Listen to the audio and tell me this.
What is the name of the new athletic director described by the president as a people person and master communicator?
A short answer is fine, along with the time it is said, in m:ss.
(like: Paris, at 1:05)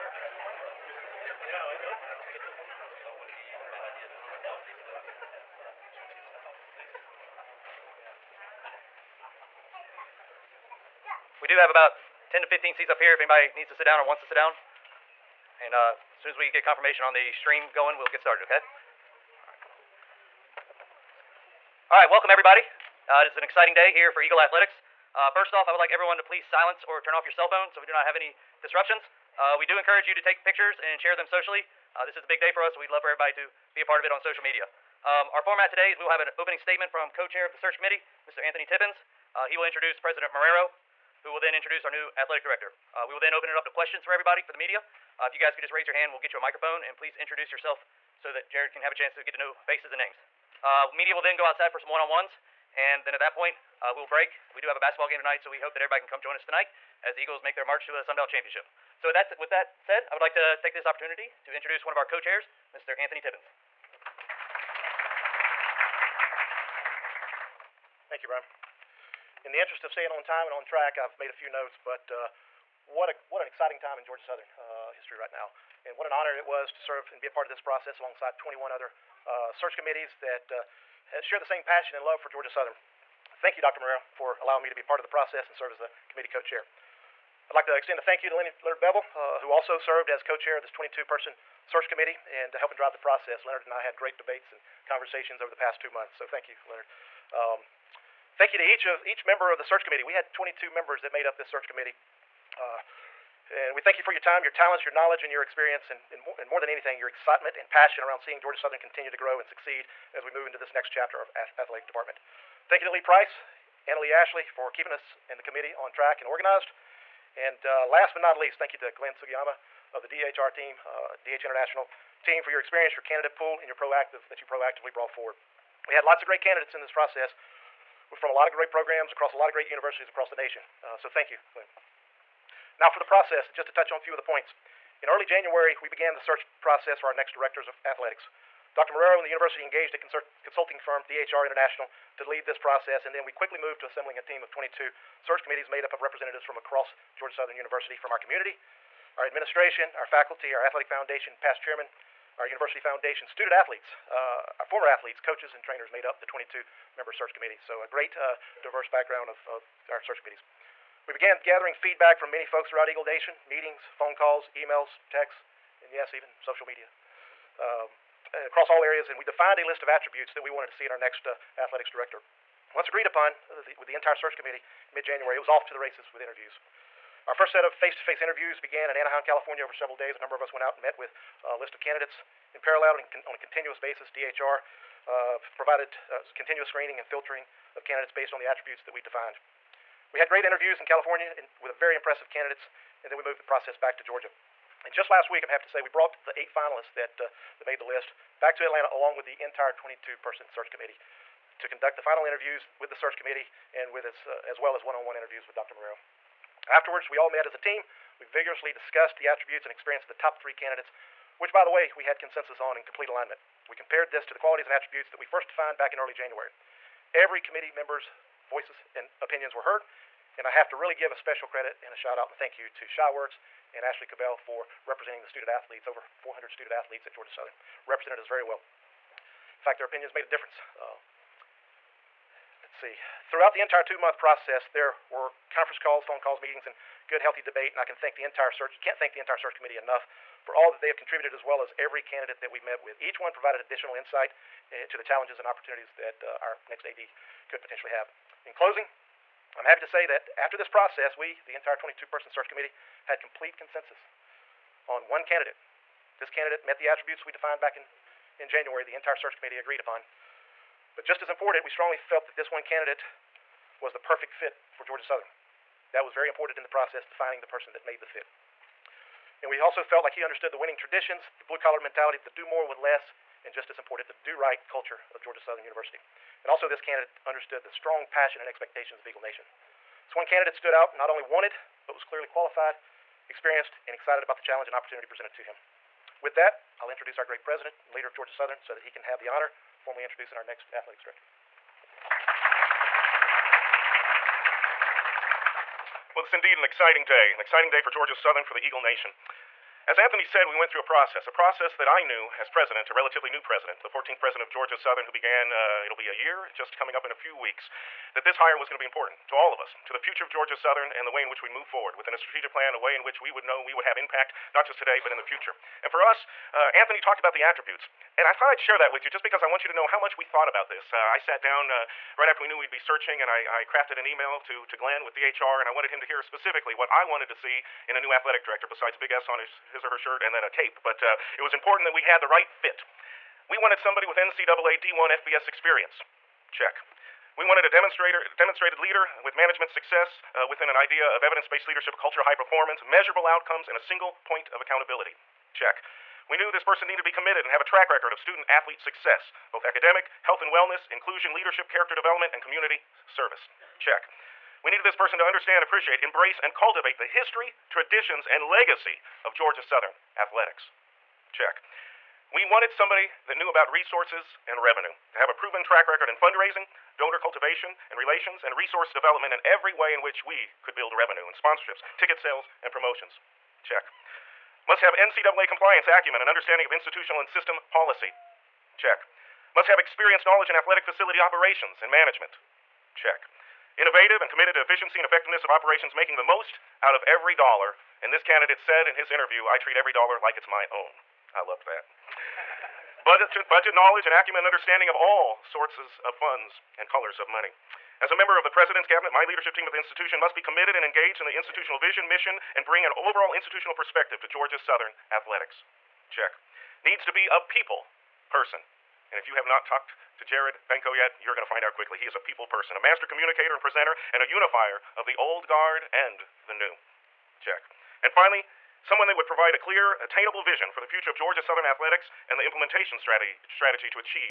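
Jared Benko, at 6:50.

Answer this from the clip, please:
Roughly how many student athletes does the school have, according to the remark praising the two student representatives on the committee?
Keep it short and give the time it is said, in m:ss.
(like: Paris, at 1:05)
over 400, at 3:45.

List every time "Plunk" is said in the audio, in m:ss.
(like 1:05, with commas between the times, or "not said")
not said.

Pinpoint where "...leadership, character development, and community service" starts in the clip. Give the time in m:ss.
5:51.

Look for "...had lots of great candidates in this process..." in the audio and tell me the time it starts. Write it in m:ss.
2:05.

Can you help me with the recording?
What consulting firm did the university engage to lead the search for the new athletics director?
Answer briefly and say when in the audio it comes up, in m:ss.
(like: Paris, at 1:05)
DHR International, at 2:21.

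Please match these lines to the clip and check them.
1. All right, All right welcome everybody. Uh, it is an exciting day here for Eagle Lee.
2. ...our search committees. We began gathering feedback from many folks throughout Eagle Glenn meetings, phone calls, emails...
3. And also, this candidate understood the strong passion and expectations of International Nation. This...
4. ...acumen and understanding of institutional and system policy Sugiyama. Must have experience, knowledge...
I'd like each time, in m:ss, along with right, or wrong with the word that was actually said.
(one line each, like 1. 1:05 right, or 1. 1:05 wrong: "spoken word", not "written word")
1. 0:19 wrong: "Athletics", not "Lee"
2. 2:39 wrong: "Nation", not "Glenn"
3. 4:36 wrong: "Eagle", not "International"
4. 6:15 wrong: "Check", not "Sugiyama".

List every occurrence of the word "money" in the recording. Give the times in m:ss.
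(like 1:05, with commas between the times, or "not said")
6:37.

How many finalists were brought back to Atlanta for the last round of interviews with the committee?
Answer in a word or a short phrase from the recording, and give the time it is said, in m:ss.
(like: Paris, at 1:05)
8, at 3:16.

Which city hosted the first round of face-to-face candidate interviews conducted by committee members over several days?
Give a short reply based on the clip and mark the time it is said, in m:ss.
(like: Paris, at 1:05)
Anaheim, California, at 2:58.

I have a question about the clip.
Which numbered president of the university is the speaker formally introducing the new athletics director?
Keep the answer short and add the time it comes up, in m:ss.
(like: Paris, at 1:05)
14th, at 5:03.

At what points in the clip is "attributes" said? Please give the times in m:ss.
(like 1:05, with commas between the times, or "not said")
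2:49, 3:08, 3:29, 3:34, 4:16, 5:17.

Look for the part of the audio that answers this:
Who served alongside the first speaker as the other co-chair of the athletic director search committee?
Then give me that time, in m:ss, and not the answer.
1:28.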